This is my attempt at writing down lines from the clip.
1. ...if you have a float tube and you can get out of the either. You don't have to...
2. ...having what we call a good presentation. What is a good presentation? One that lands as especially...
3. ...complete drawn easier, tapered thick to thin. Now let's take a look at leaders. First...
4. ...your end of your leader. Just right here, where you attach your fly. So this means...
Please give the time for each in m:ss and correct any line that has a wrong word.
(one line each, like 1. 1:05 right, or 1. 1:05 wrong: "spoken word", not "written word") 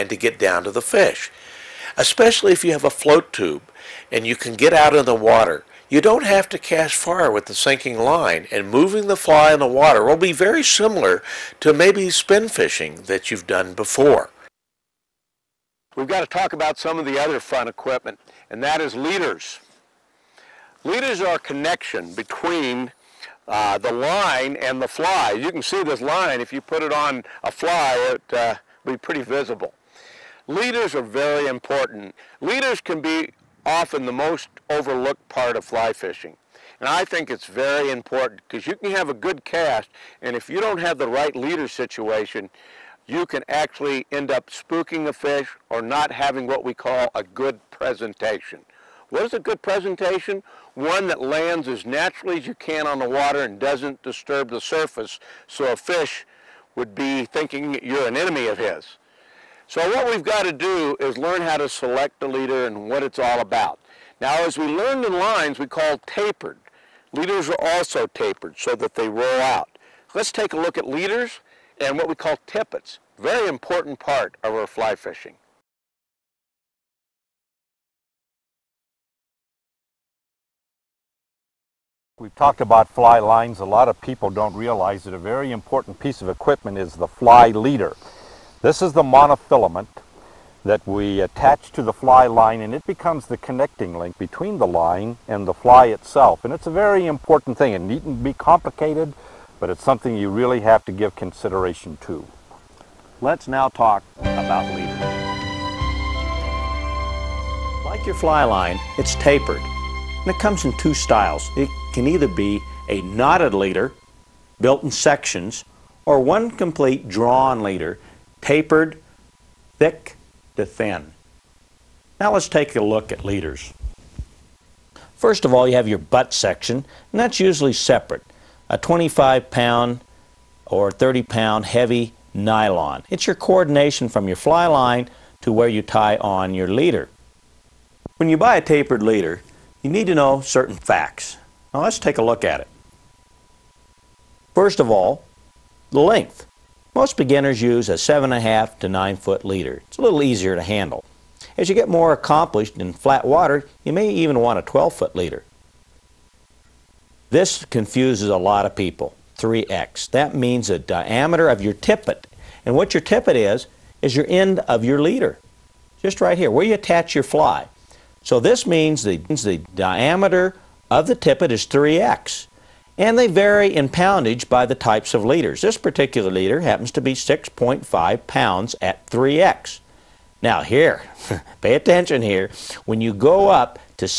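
1. 0:02 wrong: "water", not "either"
2. 0:46 wrong: "naturally", not "especially"
3. 1:56 wrong: "leader", not "easier"
4. 2:44 right.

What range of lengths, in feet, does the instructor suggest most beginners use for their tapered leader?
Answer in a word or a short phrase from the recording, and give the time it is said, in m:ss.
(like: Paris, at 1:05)
7.5 to 9 foot, at 2:27.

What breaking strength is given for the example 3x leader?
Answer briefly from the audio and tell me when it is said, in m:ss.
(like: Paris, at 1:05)
6.5 pounds, at 2:57.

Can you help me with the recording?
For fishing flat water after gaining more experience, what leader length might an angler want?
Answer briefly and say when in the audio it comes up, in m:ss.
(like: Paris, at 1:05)
12 foot, at 2:34.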